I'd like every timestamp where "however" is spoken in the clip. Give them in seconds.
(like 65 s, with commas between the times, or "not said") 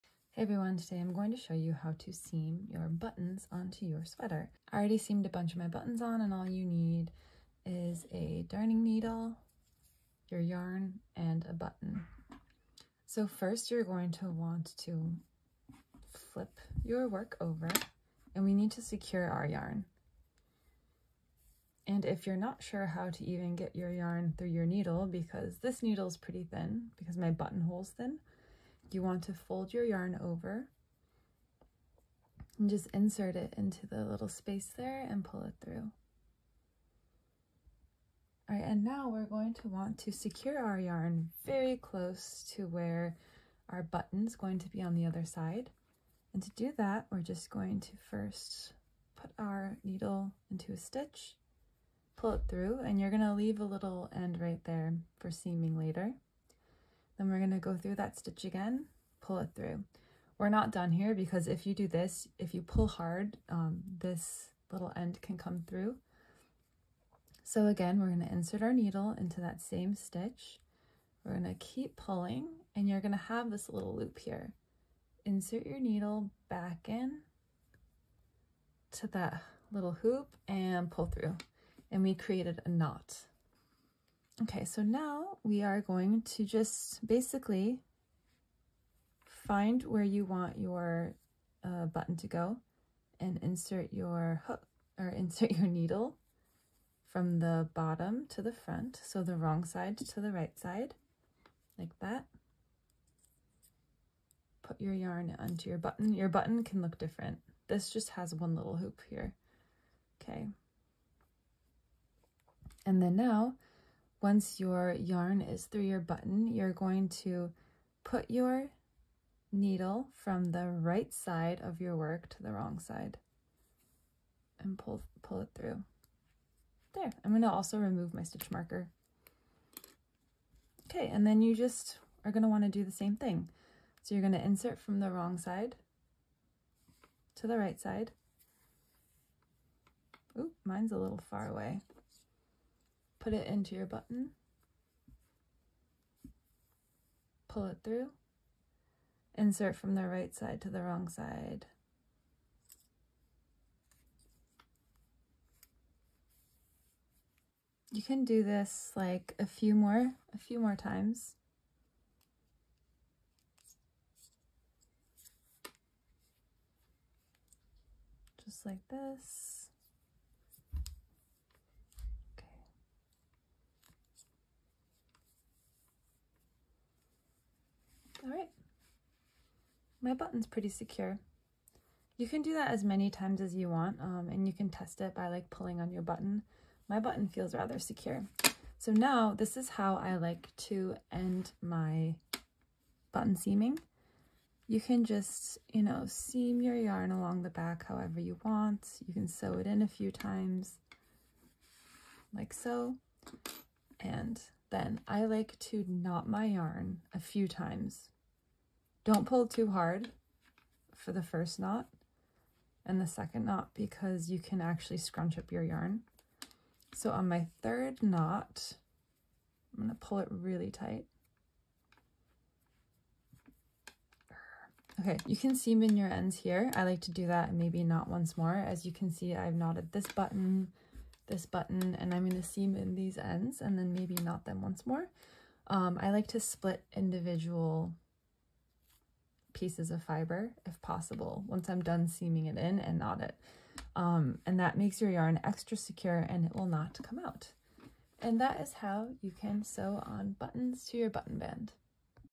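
197 s.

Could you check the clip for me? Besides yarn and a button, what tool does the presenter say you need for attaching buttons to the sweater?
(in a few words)
darning needle.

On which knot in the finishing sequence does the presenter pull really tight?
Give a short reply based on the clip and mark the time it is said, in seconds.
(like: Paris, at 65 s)
third knot, at 217 s.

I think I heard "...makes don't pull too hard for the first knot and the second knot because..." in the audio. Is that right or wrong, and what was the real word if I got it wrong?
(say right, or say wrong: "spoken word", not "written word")
wrong: "times", not "makes".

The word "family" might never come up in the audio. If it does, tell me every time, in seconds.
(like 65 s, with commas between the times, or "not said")
not said.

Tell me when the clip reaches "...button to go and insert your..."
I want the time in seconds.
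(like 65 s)
91 s.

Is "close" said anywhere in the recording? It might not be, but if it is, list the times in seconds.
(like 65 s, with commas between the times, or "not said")
41 s.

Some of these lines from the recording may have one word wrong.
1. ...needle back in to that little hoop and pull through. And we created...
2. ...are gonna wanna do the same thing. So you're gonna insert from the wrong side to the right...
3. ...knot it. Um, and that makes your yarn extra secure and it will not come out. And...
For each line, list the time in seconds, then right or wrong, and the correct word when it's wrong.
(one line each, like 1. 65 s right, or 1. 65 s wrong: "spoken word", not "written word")
1. 75 s right
2. 132 s right
3. 242 s right.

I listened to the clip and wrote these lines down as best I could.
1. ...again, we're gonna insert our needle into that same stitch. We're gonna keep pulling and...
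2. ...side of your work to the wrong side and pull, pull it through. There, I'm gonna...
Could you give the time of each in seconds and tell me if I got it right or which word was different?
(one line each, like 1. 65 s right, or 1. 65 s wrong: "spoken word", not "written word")
1. 67 s right
2. 121 s right.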